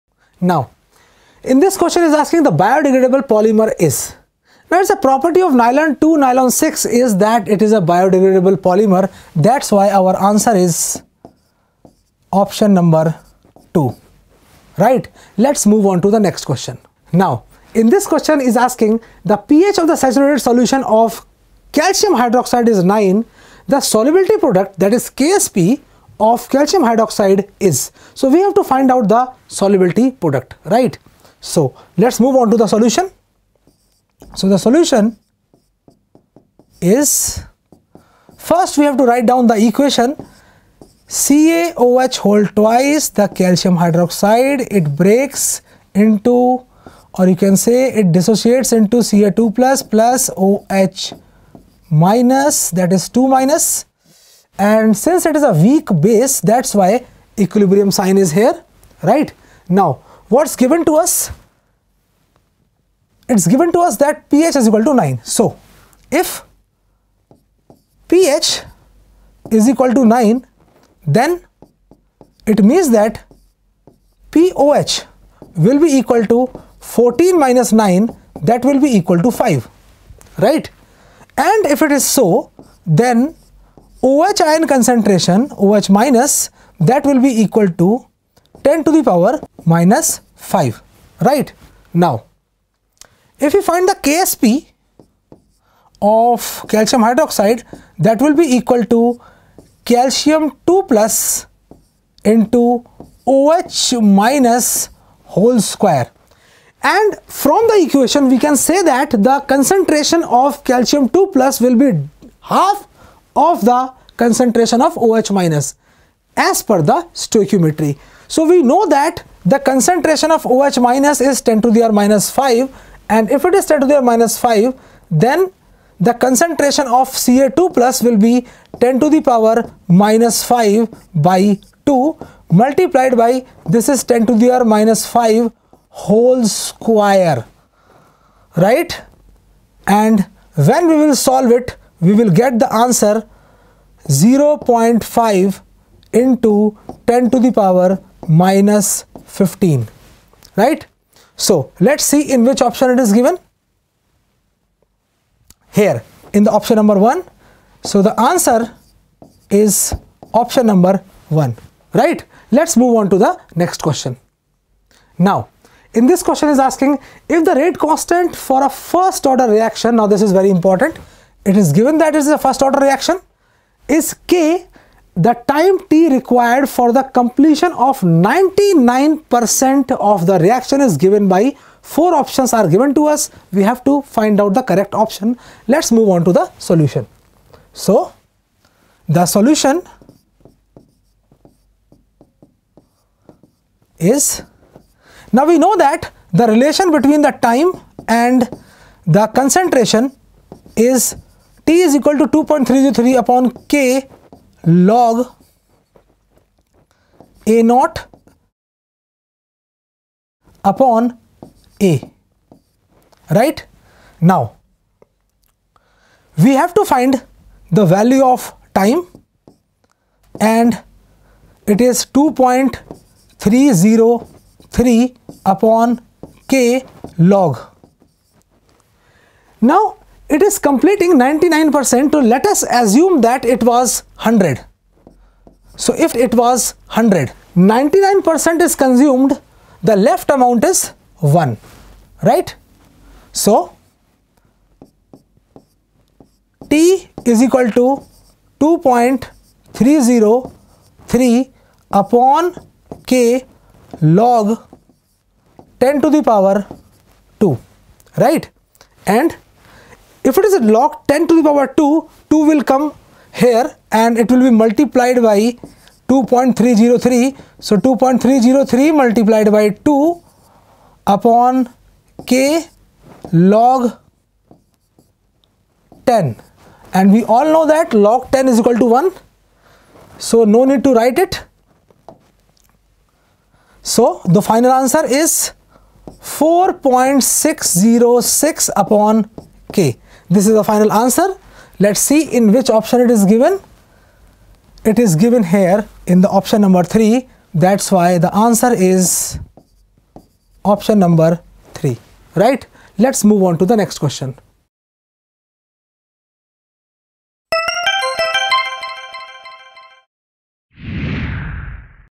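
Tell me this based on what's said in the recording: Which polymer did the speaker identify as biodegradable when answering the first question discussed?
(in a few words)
Nylon 2 nylon 6.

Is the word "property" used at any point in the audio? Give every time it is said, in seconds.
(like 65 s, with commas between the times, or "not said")
4 s.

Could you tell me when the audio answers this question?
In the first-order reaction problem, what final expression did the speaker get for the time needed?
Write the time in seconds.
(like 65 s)
286 s.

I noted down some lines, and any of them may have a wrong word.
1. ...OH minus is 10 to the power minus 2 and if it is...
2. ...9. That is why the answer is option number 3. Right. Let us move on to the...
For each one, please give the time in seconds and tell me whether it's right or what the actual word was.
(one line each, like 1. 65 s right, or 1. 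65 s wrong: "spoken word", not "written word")
1. 120 s wrong: "5", not "2"
2. 296 s wrong: "3", not "9".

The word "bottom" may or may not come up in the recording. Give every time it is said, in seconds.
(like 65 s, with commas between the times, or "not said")
not said.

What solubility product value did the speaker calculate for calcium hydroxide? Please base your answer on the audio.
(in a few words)
0.5 × 10^-15.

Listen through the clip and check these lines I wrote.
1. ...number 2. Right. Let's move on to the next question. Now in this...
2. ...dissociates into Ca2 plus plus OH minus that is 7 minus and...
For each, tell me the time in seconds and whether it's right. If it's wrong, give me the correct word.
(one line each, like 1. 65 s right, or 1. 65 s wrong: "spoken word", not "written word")
1. 12 s right
2. 48 s wrong: "2", not "7".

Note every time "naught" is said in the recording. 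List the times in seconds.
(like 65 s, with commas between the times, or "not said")
207 s.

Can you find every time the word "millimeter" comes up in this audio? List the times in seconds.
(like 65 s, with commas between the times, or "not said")
not said.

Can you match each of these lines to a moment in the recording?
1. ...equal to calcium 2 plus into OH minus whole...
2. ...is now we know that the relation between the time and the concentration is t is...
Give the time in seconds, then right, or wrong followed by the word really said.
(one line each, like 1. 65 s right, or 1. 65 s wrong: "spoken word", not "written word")
1. 98 s right
2. 193 s right.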